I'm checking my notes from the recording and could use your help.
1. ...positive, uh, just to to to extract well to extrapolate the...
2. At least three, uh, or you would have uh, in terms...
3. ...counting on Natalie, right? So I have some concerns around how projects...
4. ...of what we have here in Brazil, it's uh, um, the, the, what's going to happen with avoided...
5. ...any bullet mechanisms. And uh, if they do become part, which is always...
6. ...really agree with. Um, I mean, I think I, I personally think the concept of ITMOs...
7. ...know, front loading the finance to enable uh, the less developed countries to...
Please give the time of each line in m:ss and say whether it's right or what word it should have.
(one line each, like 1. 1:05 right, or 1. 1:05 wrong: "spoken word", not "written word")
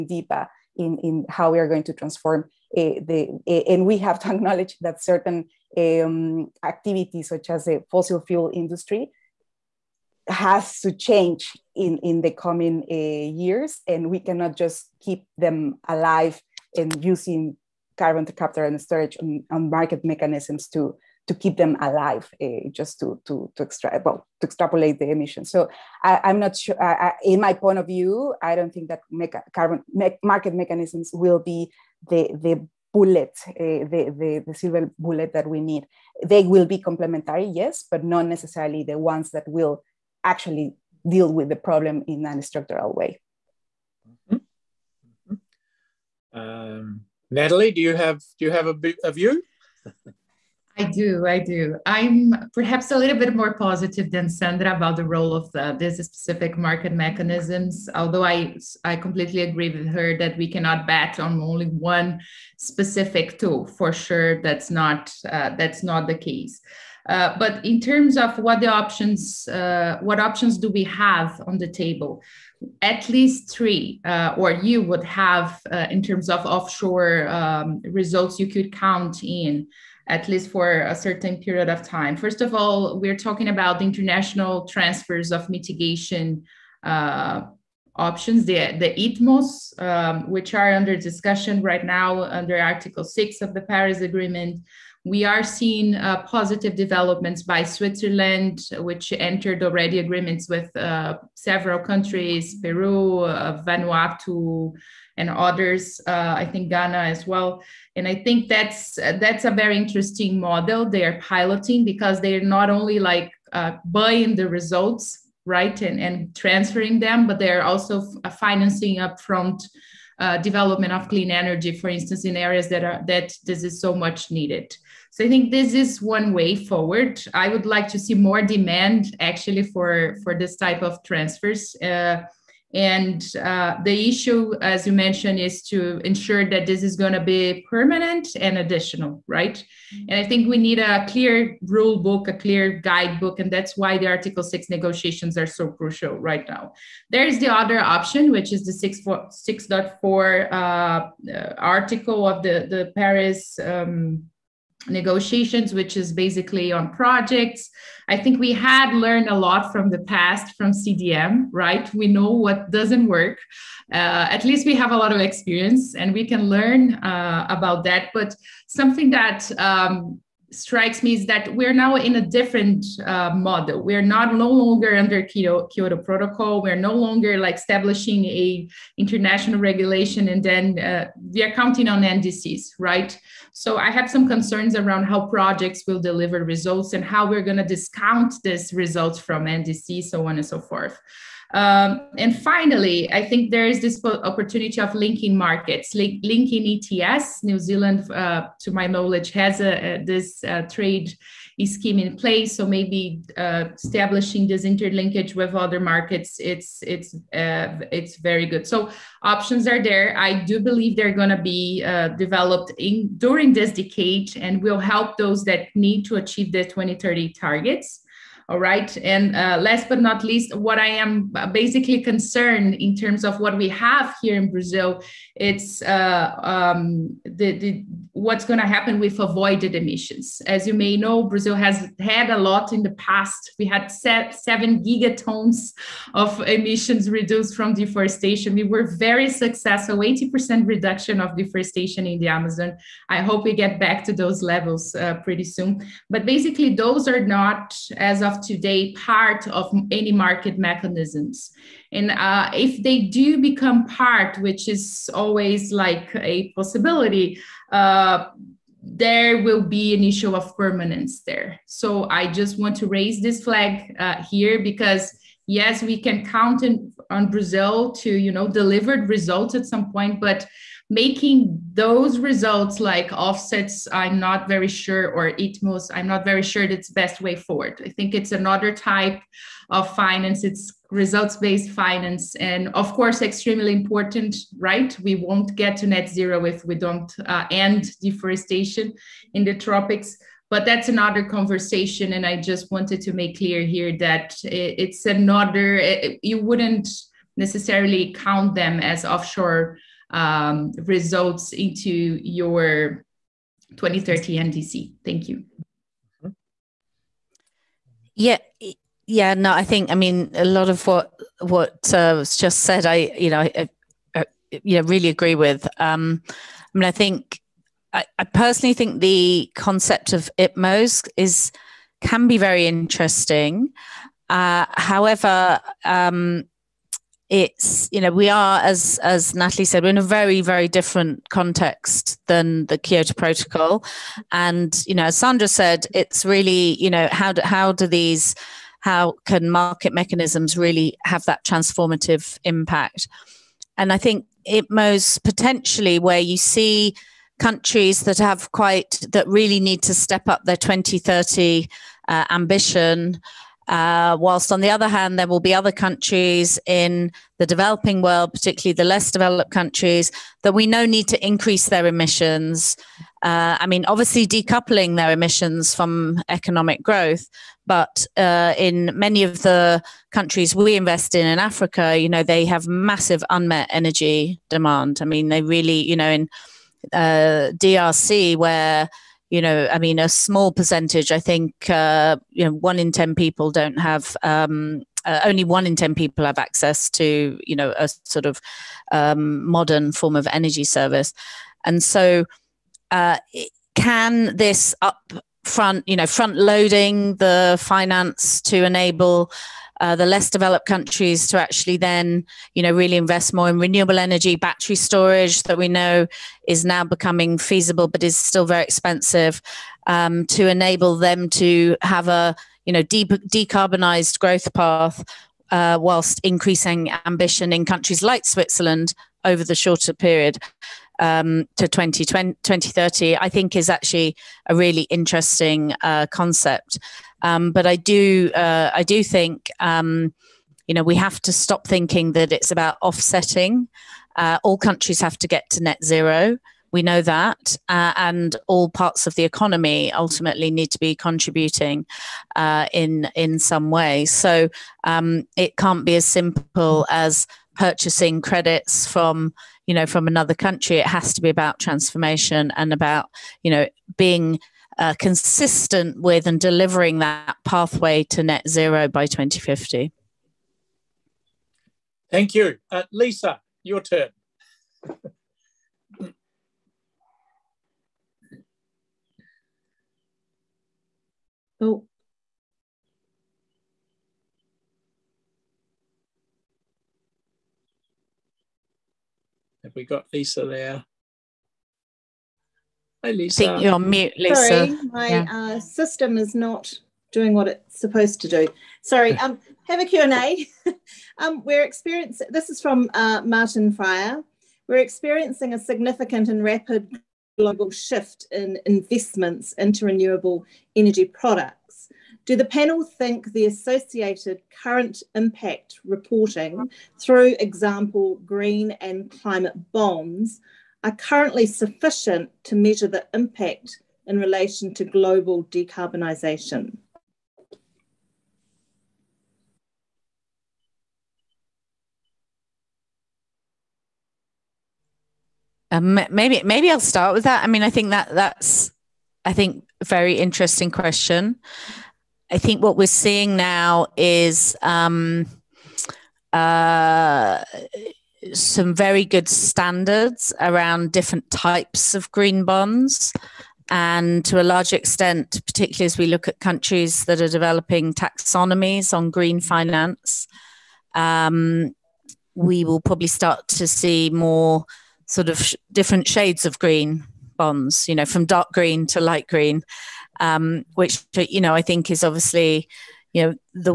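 1. 0:21 wrong: "alive", not "positive"
2. 1:12 right
3. 3:01 wrong: "NDCs", not "Natalie"
4. 3:43 right
5. 4:09 wrong: "market", not "bullet"
6. 5:14 right
7. 6:35 right.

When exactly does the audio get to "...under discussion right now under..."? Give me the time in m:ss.
1:30.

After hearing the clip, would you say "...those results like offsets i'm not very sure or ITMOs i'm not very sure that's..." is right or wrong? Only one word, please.
right.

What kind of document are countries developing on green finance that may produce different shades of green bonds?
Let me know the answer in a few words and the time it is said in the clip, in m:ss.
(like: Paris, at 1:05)
taxonomies, at 9:07.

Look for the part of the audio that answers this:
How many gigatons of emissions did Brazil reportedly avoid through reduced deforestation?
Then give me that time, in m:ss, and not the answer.
3:53.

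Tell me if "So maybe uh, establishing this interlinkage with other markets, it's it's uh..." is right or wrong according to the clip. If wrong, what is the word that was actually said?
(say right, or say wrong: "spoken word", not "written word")
right.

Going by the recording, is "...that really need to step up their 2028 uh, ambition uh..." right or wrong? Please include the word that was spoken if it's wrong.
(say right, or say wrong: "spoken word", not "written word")
wrong: "2030", not "2028".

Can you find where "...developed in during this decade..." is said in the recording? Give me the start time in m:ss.
3:32.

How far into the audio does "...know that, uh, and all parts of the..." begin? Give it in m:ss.
7:16.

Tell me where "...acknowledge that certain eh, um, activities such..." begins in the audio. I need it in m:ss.
0:04.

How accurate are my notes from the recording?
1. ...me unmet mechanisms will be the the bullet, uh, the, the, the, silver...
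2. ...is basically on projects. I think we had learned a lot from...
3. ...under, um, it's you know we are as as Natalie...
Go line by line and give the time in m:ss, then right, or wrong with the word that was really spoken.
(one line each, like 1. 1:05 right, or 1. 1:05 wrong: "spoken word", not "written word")
1. 0:29 wrong: "market", not "unmet"
2. 2:35 right
3. 5:24 wrong: "however", not "under".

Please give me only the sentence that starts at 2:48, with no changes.
But something that um, strikes me is that we're now in a different uh, model.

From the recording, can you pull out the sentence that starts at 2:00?
Uh, development of clean energy, for instance, in areas that are that this is so much needed.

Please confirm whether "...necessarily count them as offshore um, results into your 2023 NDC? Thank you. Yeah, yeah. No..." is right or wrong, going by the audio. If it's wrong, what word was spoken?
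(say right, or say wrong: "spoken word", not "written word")
wrong: "2030", not "2023".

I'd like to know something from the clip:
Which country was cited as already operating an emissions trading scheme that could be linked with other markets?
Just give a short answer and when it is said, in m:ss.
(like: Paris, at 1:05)
New Zealand, at 3:17.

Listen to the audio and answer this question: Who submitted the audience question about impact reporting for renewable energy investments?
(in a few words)
Martin Fryer.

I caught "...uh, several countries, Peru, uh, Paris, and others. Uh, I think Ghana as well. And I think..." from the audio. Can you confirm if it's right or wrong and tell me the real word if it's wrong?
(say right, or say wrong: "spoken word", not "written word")
wrong: "Vanuatu", not "Paris".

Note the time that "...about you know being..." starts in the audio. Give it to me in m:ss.
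7:32.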